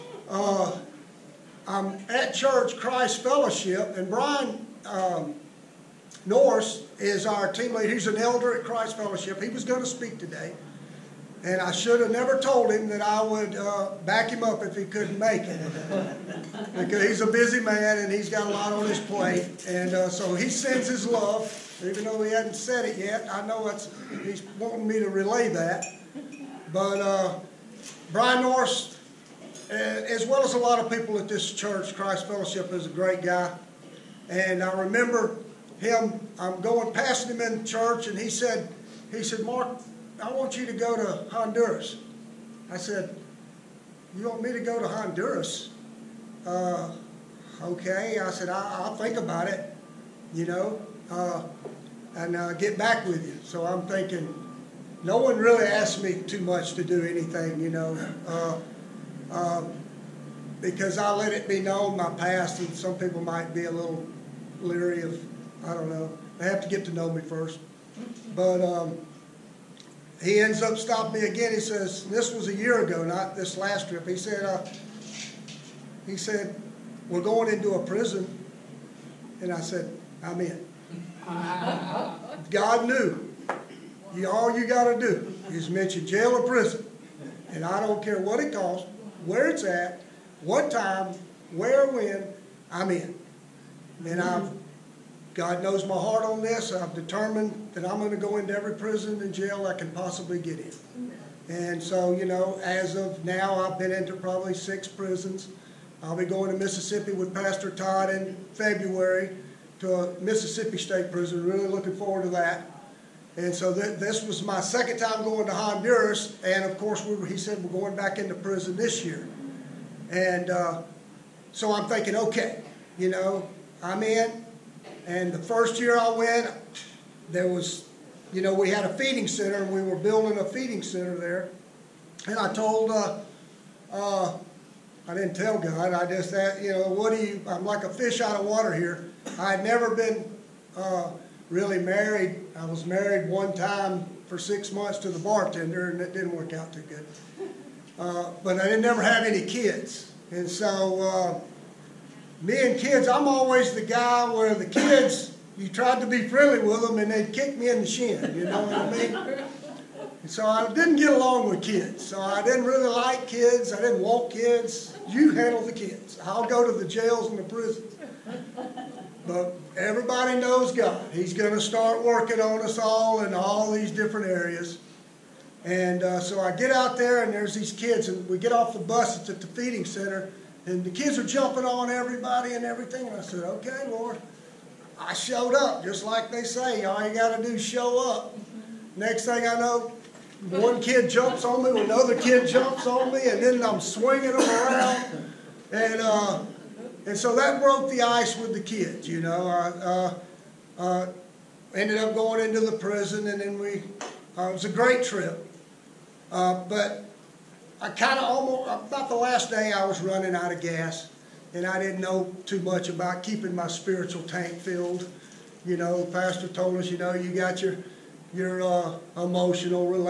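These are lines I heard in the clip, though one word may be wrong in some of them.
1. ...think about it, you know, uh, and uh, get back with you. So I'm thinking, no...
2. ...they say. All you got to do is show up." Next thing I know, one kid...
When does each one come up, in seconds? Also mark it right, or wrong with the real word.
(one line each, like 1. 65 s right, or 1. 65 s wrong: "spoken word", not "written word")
1. 48 s right
2. 186 s right.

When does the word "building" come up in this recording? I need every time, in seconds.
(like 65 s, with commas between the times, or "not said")
129 s.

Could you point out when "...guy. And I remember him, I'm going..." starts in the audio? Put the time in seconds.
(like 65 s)
33 s.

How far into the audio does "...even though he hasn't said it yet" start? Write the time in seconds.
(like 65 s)
21 s.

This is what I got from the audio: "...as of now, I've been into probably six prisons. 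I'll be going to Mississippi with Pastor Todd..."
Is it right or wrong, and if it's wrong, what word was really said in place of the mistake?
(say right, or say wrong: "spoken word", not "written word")
right.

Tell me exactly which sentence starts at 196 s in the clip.
Uh, and so that broke the ice with the kids, you know.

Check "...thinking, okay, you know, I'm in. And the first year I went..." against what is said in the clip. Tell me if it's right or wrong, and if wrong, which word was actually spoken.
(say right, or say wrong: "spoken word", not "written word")
right.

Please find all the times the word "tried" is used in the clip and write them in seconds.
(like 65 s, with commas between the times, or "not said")
155 s.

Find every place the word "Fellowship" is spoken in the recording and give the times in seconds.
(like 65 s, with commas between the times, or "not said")
3 s, 8 s, 32 s.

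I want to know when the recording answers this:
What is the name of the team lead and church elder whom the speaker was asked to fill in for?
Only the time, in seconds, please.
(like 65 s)
4 s.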